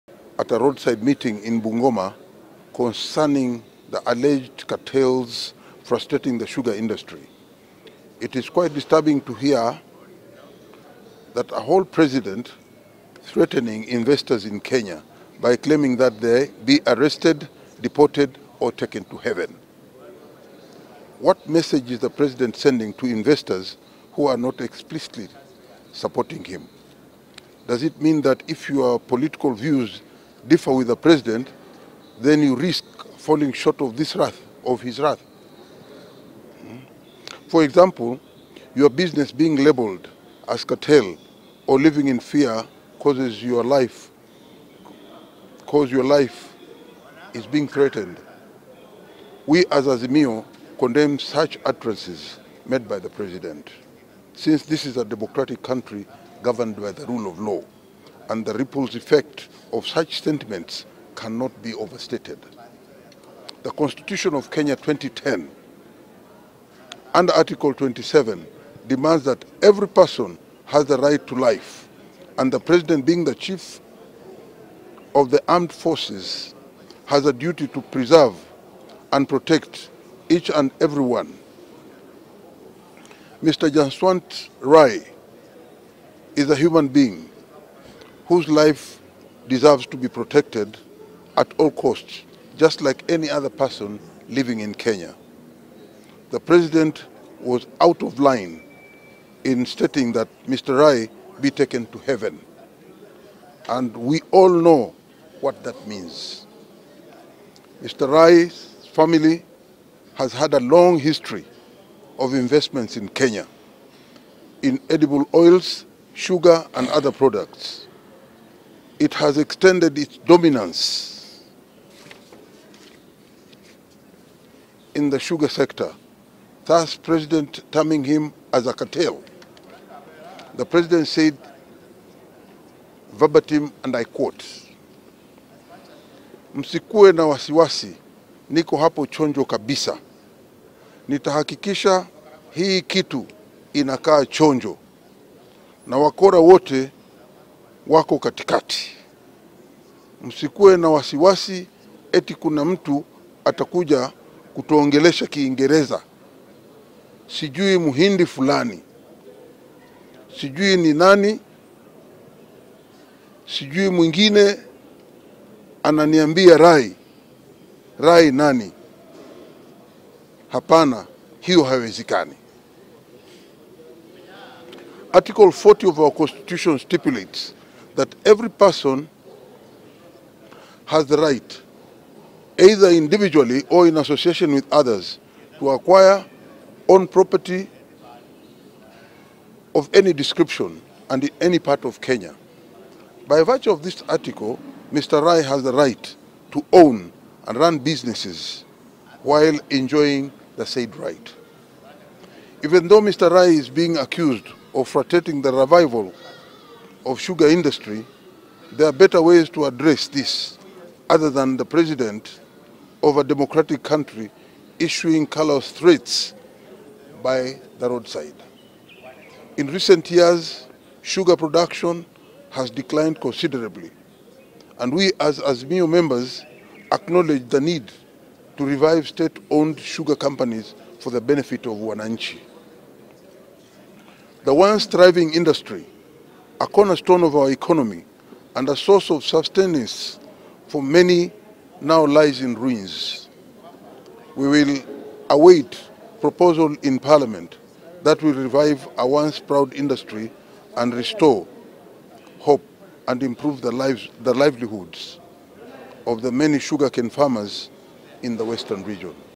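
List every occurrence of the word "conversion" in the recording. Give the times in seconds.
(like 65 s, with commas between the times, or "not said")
not said.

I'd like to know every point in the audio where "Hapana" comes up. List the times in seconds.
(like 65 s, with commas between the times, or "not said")
170 s.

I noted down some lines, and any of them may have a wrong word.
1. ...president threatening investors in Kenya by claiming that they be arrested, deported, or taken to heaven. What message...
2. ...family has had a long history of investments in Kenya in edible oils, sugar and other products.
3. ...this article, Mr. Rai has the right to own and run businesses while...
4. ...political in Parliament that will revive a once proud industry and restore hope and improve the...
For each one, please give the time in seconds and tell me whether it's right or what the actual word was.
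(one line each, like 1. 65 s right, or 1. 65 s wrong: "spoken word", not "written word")
1. 11 s right
2. 108 s right
3. 193 s right
4. 246 s wrong: "proposal", not "political".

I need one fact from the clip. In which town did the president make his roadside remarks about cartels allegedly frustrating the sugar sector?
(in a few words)
Bungoma.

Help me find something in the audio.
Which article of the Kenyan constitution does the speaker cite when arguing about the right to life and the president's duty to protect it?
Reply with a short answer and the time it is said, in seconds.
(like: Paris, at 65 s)
Article 27, at 67 s.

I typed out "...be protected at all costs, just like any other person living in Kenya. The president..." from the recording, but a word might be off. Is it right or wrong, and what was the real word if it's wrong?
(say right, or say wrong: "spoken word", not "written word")
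right.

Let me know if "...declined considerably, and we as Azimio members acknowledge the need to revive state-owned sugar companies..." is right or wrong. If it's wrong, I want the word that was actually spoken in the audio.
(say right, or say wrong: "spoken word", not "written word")
right.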